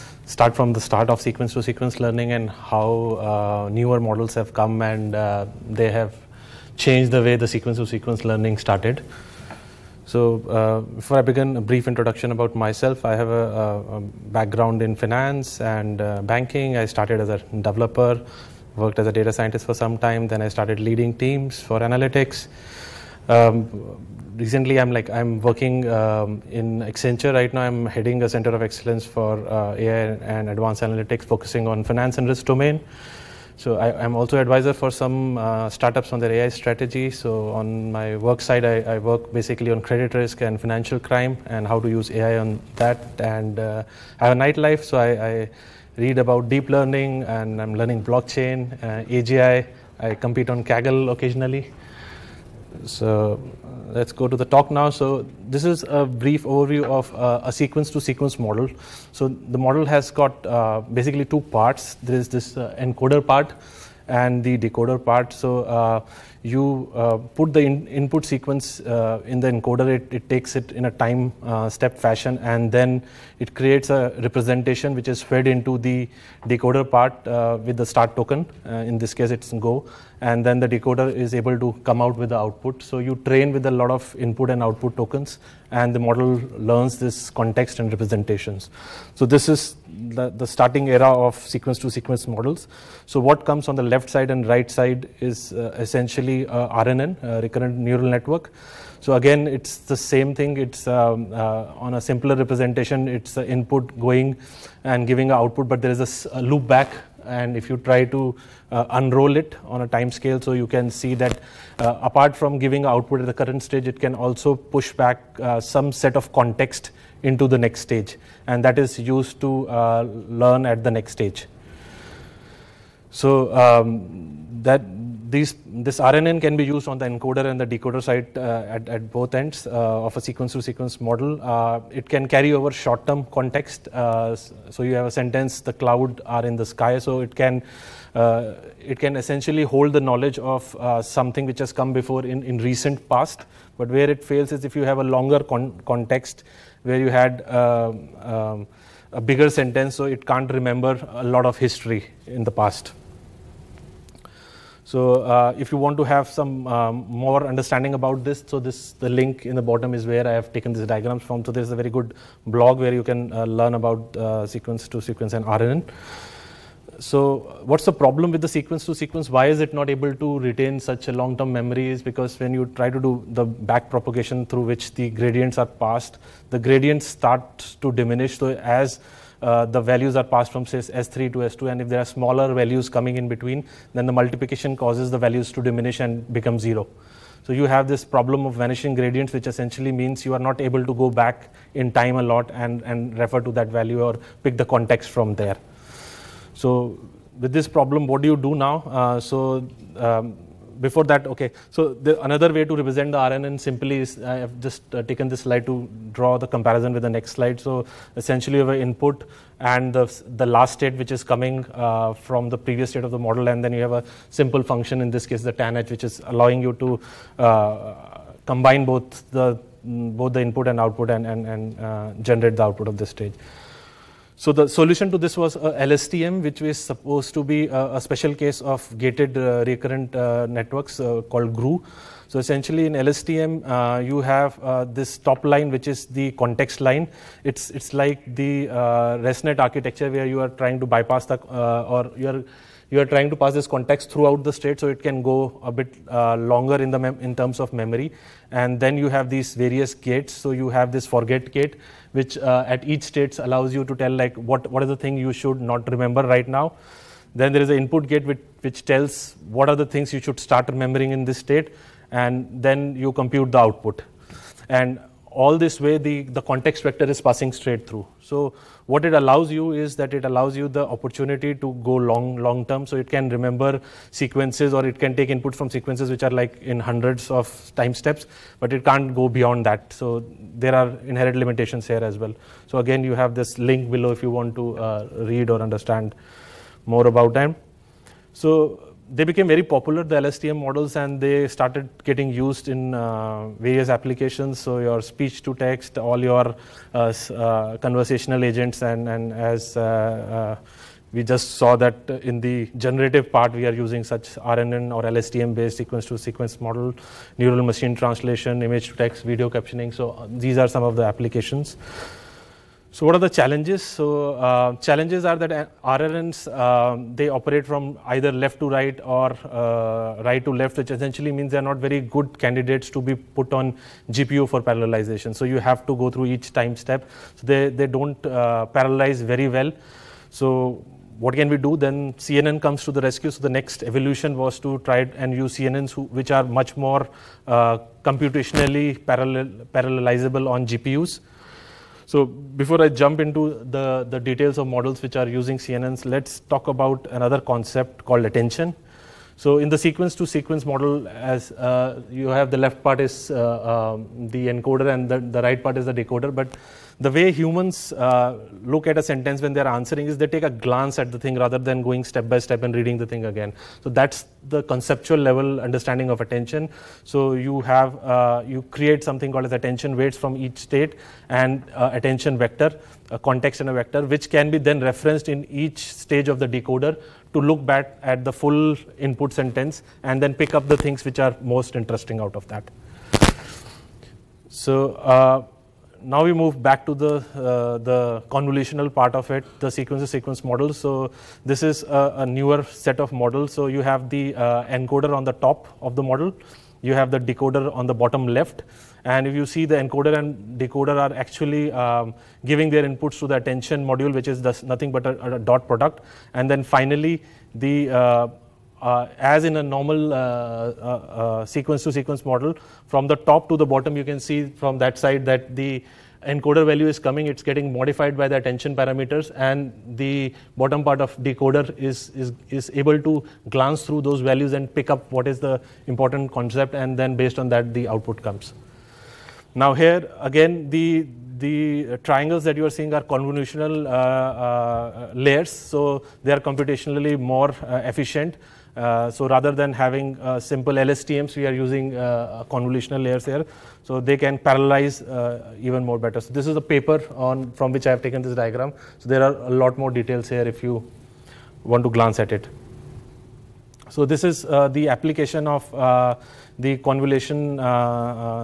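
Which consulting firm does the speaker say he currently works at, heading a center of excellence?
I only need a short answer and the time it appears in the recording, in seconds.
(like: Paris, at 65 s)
Accenture, at 26 s.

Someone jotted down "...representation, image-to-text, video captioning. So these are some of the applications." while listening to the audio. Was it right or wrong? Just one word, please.
wrong.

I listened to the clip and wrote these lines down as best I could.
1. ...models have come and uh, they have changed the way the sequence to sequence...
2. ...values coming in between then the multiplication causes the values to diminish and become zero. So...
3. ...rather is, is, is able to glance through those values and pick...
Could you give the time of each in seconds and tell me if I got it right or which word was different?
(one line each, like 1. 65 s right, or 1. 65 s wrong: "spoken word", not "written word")
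1. 3 s right
2. 182 s right
3. 421 s wrong: "decoder", not "rather".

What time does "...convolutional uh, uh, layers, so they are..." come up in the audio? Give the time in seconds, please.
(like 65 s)
433 s.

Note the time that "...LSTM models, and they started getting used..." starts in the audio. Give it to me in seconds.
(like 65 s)
290 s.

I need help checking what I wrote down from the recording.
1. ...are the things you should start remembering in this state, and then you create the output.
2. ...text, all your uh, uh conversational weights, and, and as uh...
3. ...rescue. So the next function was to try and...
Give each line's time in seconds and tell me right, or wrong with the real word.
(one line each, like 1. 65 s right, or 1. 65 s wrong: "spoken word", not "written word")
1. 259 s wrong: "compute", not "create"
2. 295 s wrong: "agents", not "weights"
3. 333 s wrong: "evolution", not "function".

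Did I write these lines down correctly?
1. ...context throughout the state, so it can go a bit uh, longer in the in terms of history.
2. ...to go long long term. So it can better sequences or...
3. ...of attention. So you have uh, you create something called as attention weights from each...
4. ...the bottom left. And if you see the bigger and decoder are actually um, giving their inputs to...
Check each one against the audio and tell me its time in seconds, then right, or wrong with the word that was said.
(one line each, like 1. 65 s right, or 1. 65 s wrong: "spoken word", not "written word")
1. 243 s wrong: "memory", not "history"
2. 271 s wrong: "remember", not "better"
3. 366 s right
4. 397 s wrong: "encoder", not "bigger".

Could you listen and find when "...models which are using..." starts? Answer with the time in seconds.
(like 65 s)
344 s.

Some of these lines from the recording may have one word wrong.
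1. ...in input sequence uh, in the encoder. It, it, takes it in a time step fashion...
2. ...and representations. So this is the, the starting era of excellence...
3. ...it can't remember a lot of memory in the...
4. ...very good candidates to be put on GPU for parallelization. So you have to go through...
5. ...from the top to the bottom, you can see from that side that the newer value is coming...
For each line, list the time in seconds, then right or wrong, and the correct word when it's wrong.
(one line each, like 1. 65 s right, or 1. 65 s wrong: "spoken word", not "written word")
1. 67 s right
2. 87 s wrong: "sequence", not "excellence"
3. 150 s wrong: "history", not "memory"
4. 321 s right
5. 412 s wrong: "encoder", not "newer".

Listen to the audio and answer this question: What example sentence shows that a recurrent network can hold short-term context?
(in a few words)
The cloud are in the sky.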